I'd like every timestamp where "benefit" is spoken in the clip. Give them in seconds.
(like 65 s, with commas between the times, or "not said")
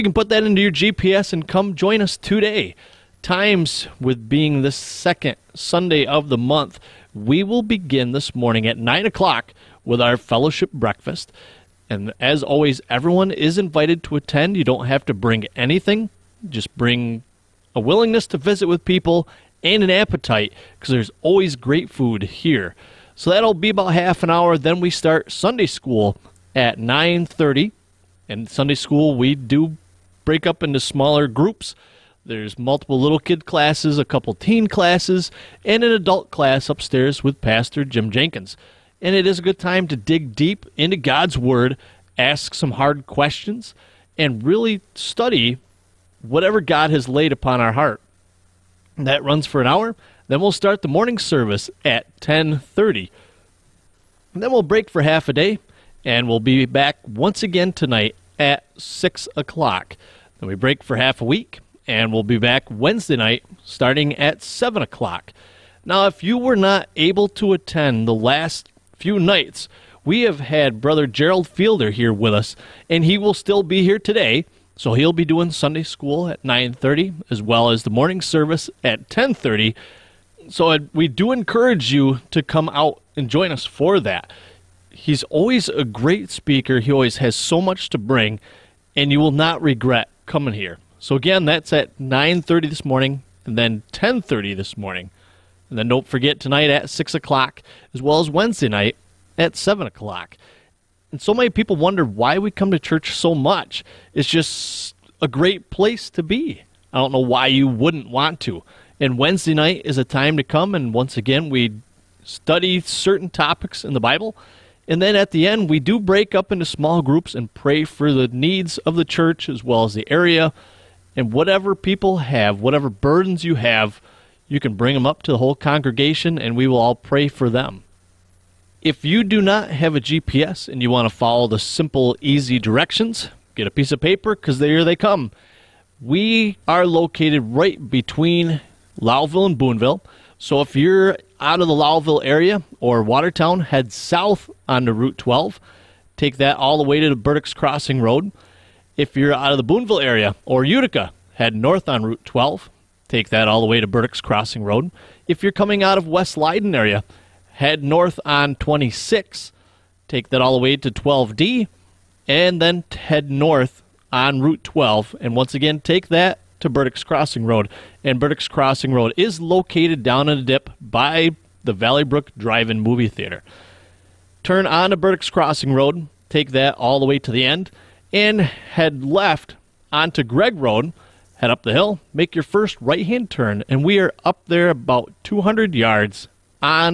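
not said.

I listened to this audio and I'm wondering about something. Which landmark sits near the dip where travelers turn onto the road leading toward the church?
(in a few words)
Valley Brook Drive In Movie Theater.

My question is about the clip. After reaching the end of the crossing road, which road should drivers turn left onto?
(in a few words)
Greig Road.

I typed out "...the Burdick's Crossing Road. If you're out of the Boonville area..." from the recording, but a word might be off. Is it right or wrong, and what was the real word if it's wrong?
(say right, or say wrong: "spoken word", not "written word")
right.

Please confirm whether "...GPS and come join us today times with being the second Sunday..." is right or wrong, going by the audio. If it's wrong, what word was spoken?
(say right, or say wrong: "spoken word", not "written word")
right.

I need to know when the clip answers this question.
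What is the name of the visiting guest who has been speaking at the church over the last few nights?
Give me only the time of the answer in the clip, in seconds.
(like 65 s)
71 s.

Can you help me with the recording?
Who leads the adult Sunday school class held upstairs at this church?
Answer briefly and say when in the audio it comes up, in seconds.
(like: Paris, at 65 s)
Pastor Jim Jenkins, at 37 s.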